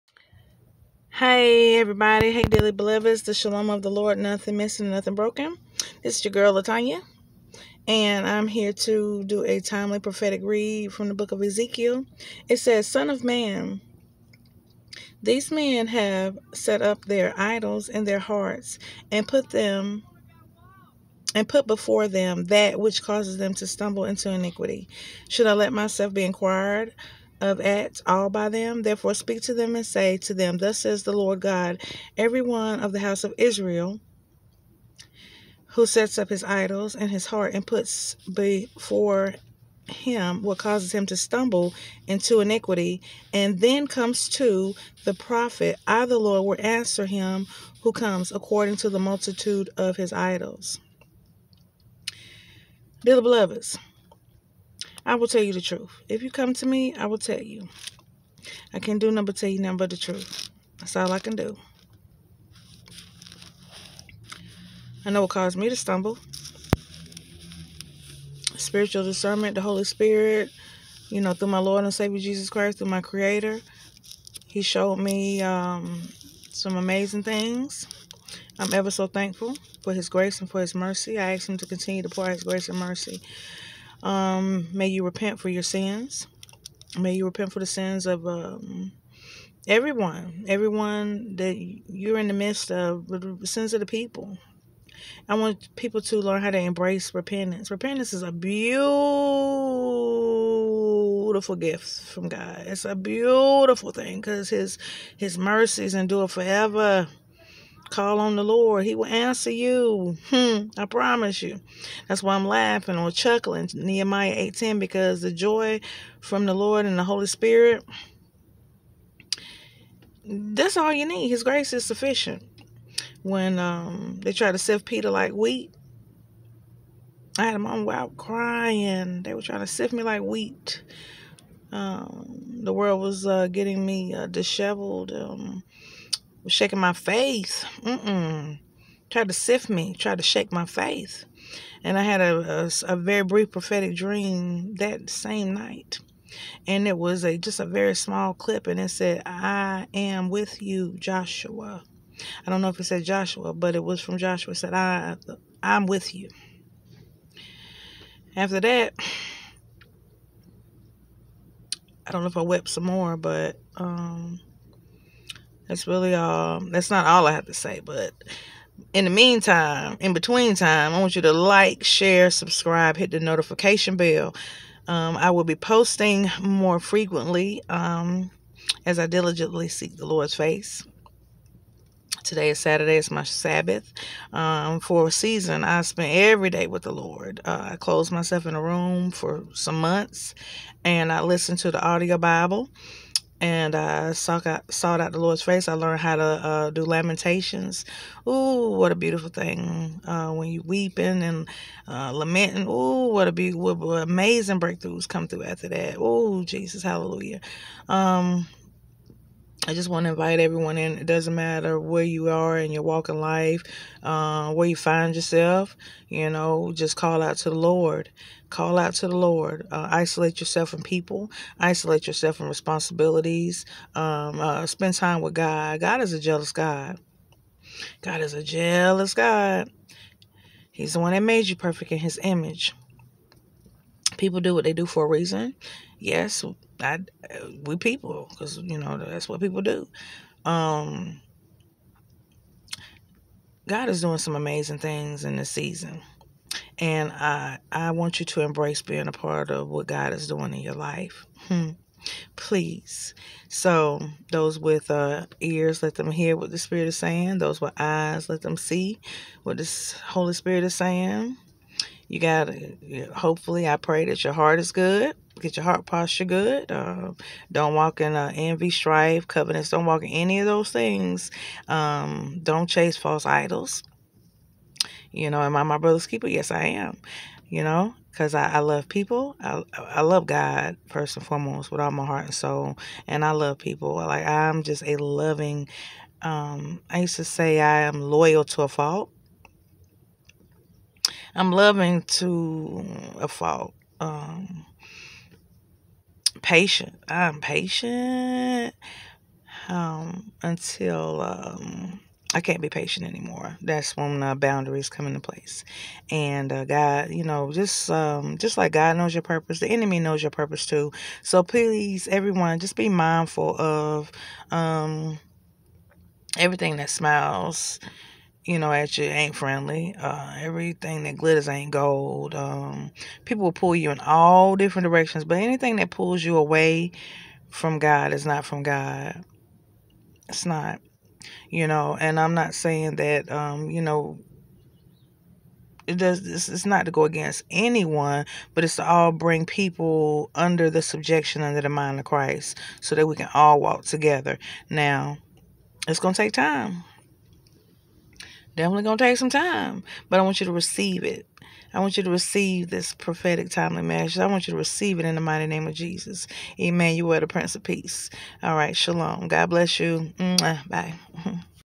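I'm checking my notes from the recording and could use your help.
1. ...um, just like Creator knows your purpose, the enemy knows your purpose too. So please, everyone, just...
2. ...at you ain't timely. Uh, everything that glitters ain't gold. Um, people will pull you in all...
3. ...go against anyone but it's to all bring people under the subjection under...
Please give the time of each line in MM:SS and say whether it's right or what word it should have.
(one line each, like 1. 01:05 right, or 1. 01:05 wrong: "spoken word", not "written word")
1. 05:07 wrong: "God", not "Creator"
2. 05:18 wrong: "friendly", not "timely"
3. 05:36 right.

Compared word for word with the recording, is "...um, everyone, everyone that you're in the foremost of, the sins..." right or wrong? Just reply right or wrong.
wrong.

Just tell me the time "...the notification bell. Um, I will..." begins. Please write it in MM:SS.
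02:53.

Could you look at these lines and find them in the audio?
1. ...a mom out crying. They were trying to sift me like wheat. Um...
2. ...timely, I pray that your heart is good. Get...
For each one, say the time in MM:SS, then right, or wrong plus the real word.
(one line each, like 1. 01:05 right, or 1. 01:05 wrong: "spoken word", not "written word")
1. 02:07 right
2. 04:23 wrong: "hopefully", not "timely".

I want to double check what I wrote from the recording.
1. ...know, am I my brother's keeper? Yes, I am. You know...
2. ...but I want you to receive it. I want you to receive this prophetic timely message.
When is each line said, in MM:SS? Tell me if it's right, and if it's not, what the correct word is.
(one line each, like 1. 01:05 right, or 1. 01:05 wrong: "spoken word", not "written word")
1. 04:35 right
2. 05:50 right.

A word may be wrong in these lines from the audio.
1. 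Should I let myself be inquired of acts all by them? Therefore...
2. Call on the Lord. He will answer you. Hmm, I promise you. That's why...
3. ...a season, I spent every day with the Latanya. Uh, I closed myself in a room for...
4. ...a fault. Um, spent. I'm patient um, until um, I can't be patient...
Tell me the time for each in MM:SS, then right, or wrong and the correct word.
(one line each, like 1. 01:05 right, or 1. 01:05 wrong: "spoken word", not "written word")
1. 00:25 right
2. 01:47 right
3. 03:05 wrong: "Lord", not "Latanya"
4. 04:53 wrong: "patient", not "spent".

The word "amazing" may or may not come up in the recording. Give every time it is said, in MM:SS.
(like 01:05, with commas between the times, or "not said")
01:16, 03:23, 04:04.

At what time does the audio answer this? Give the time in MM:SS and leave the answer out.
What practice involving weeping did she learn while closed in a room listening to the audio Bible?
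03:16.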